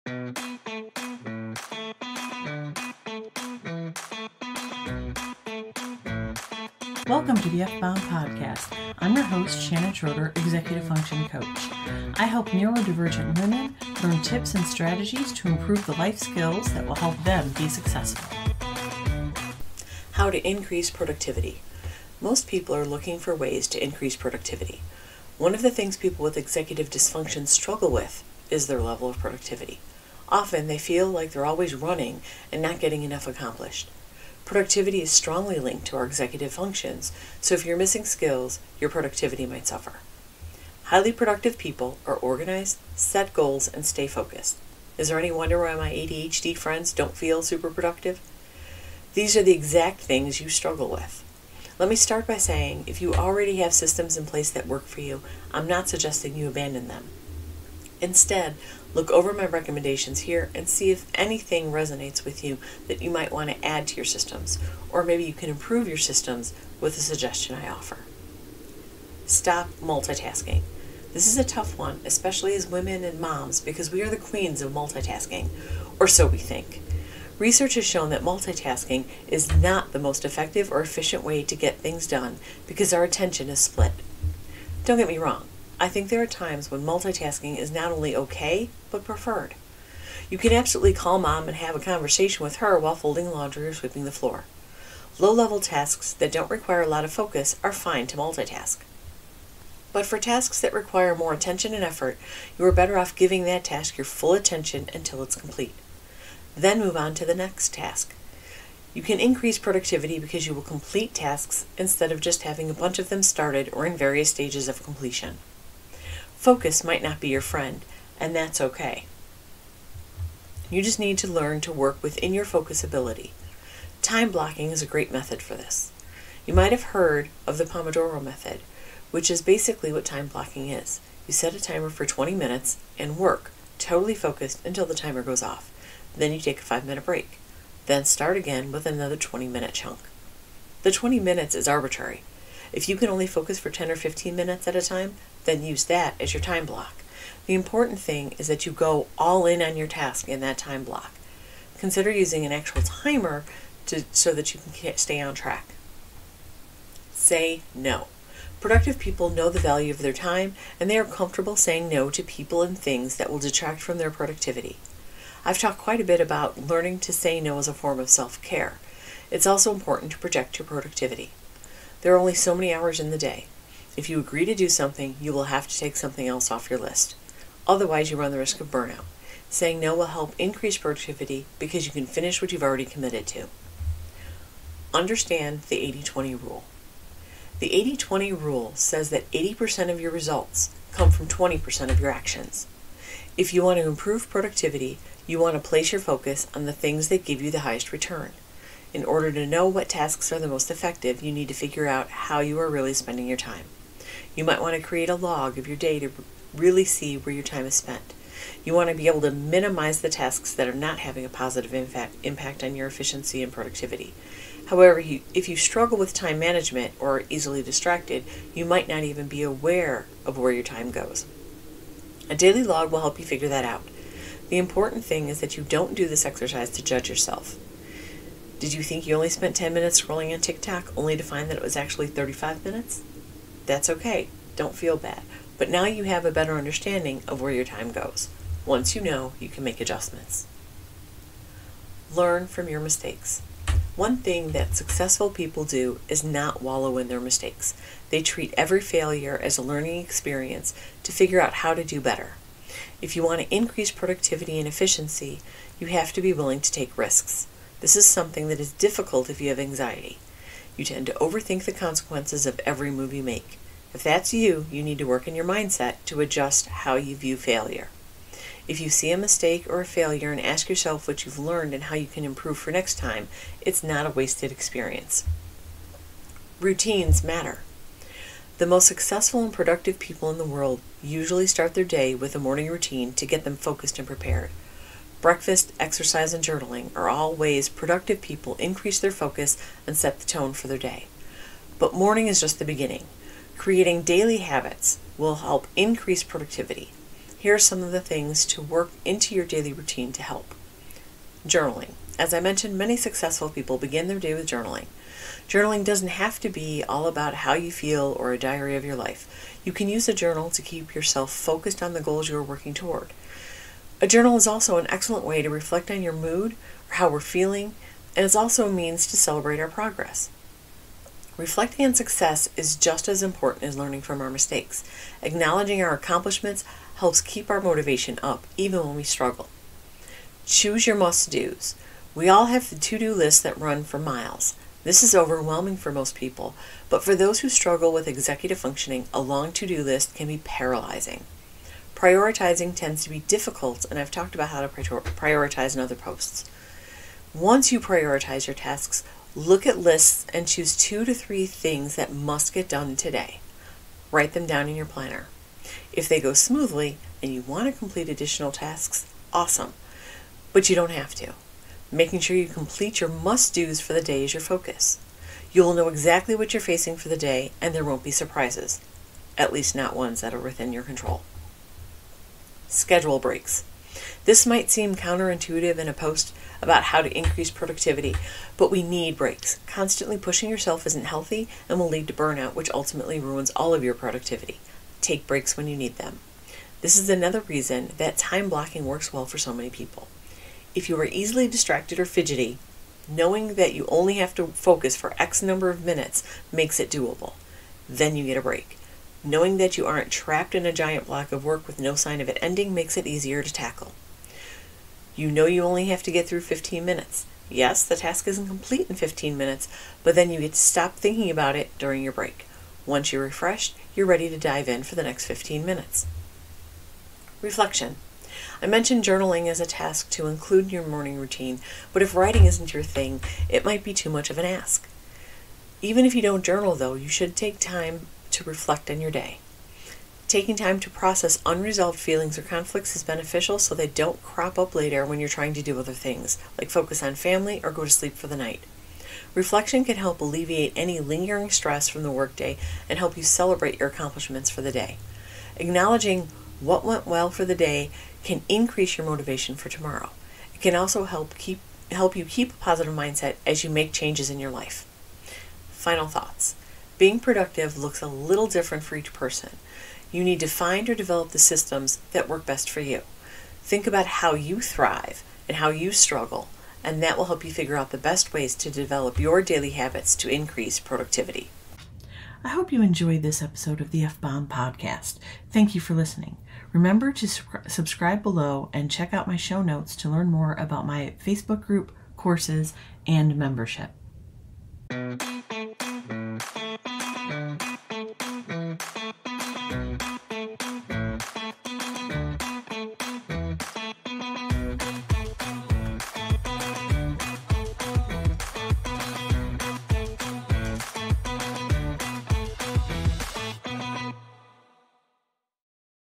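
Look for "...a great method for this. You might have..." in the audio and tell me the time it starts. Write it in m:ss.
2:04.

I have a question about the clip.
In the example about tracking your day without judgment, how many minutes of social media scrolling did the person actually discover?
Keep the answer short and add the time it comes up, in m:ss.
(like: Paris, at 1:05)
35 minutes, at 3:52.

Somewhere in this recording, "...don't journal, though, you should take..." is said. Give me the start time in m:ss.
7:06.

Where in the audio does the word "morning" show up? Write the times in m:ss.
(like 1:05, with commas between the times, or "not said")
4:42, 4:51, 7:00.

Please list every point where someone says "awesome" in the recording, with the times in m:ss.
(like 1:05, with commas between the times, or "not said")
5:59.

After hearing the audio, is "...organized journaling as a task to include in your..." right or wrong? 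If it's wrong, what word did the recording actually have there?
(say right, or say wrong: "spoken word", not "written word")
wrong: "mentioned", not "organized".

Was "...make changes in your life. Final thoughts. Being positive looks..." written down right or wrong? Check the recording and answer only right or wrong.
wrong.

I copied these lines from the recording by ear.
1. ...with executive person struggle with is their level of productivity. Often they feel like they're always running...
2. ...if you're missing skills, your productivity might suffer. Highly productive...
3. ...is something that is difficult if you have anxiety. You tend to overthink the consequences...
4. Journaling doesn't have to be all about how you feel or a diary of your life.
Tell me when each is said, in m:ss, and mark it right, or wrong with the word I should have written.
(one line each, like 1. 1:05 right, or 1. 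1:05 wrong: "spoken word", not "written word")
1. 0:26 wrong: "dysfunction", not "person"
2. 0:37 right
3. 4:17 right
4. 5:05 right.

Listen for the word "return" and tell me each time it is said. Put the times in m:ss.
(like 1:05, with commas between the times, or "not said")
3:17.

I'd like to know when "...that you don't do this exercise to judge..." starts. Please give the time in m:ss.
3:45.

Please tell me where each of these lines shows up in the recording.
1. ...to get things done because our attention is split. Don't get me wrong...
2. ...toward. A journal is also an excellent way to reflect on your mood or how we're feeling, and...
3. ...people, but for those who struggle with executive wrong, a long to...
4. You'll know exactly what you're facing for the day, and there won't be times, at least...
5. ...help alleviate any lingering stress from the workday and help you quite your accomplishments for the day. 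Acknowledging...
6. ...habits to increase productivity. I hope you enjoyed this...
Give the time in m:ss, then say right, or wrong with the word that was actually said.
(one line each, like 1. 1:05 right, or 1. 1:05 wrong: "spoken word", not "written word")
1. 1:21 right
2. 5:12 right
3. 5:36 wrong: "functioning", not "wrong"
4. 6:05 wrong: "surprises", not "times"
5. 7:19 wrong: "celebrate", not "quite"
6. 7:49 right.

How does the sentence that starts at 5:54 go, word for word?
Write them down in your planner.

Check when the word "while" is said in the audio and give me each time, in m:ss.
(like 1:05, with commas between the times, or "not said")
1:32.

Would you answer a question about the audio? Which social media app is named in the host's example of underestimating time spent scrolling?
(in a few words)
TikTok.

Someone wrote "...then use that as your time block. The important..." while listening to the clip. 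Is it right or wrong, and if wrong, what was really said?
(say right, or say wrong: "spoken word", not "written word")
right.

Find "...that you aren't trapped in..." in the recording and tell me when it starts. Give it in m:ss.
6:39.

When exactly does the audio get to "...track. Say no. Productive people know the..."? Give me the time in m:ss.
2:35.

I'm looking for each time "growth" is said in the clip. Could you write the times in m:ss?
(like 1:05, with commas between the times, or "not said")
not said.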